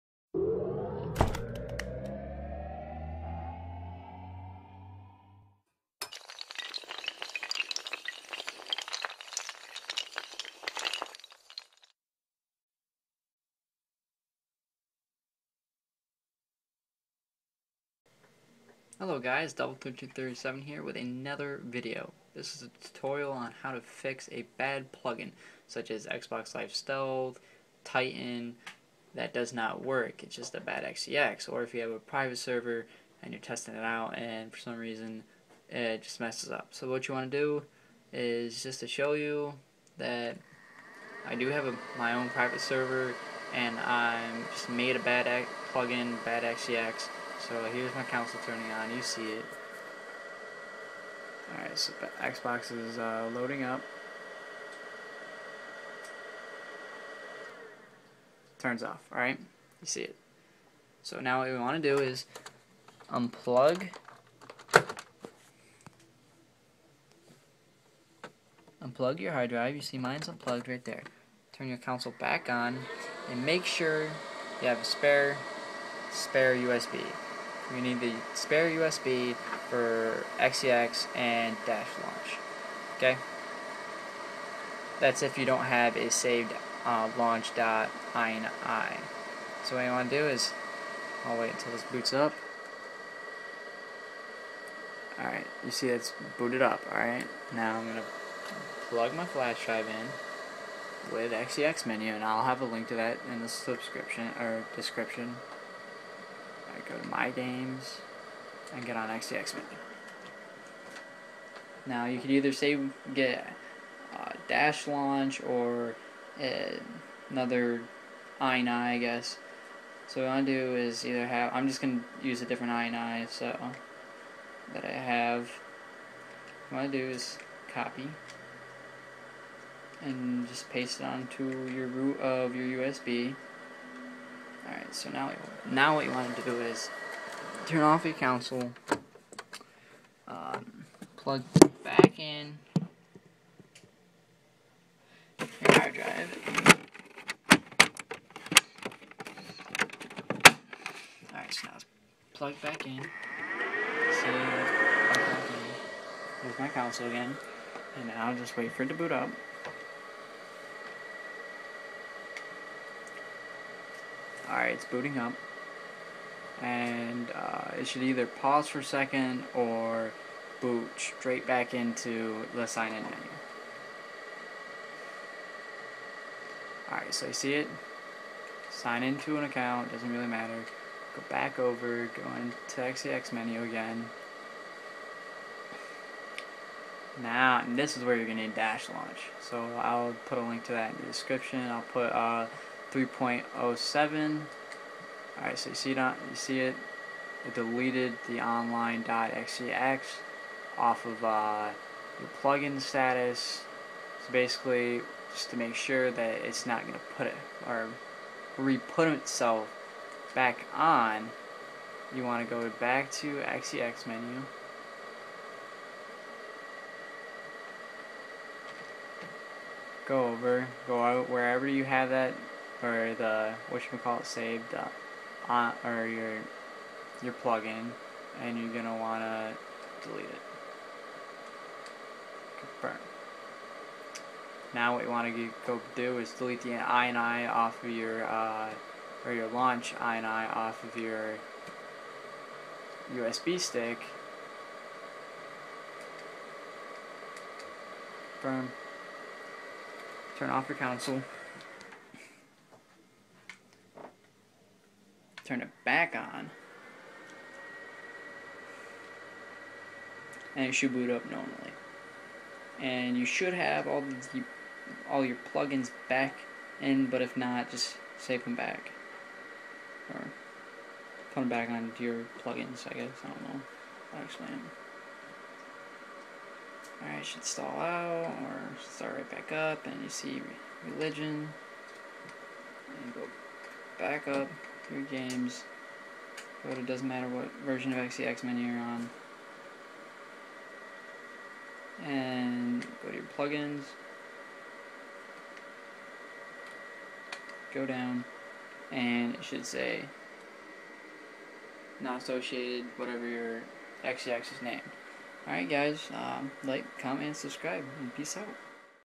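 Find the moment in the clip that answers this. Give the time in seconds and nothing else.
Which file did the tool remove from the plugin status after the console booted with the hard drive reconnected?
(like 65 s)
198 s.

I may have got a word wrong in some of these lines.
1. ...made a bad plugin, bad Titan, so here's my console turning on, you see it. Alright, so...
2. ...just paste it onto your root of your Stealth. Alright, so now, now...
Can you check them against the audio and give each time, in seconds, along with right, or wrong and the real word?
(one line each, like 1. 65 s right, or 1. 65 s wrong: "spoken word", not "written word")
1. 44 s wrong: "XEX", not "Titan"
2. 130 s wrong: "USB", not "Stealth".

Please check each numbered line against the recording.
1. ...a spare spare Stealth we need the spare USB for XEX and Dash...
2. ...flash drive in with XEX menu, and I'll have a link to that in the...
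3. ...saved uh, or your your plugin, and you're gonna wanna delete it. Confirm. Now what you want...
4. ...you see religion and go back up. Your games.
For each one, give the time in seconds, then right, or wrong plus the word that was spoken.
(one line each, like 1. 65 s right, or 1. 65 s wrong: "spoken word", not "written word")
1. 74 s wrong: "USB", not "Stealth"
2. 99 s right
3. 224 s right
4. 280 s right.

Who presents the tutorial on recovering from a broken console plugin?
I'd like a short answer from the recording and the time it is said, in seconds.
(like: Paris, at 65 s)
doubleclip, at 19 s.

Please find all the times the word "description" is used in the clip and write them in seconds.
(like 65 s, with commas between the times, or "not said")
104 s, 191 s.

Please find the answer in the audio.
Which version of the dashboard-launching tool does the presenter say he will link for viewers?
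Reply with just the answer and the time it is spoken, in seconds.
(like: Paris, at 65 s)
3.07, at 192 s.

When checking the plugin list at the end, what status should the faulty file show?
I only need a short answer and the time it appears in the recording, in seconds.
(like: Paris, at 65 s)
not associated, at 302 s.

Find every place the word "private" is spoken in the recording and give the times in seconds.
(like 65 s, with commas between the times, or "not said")
31 s, 42 s.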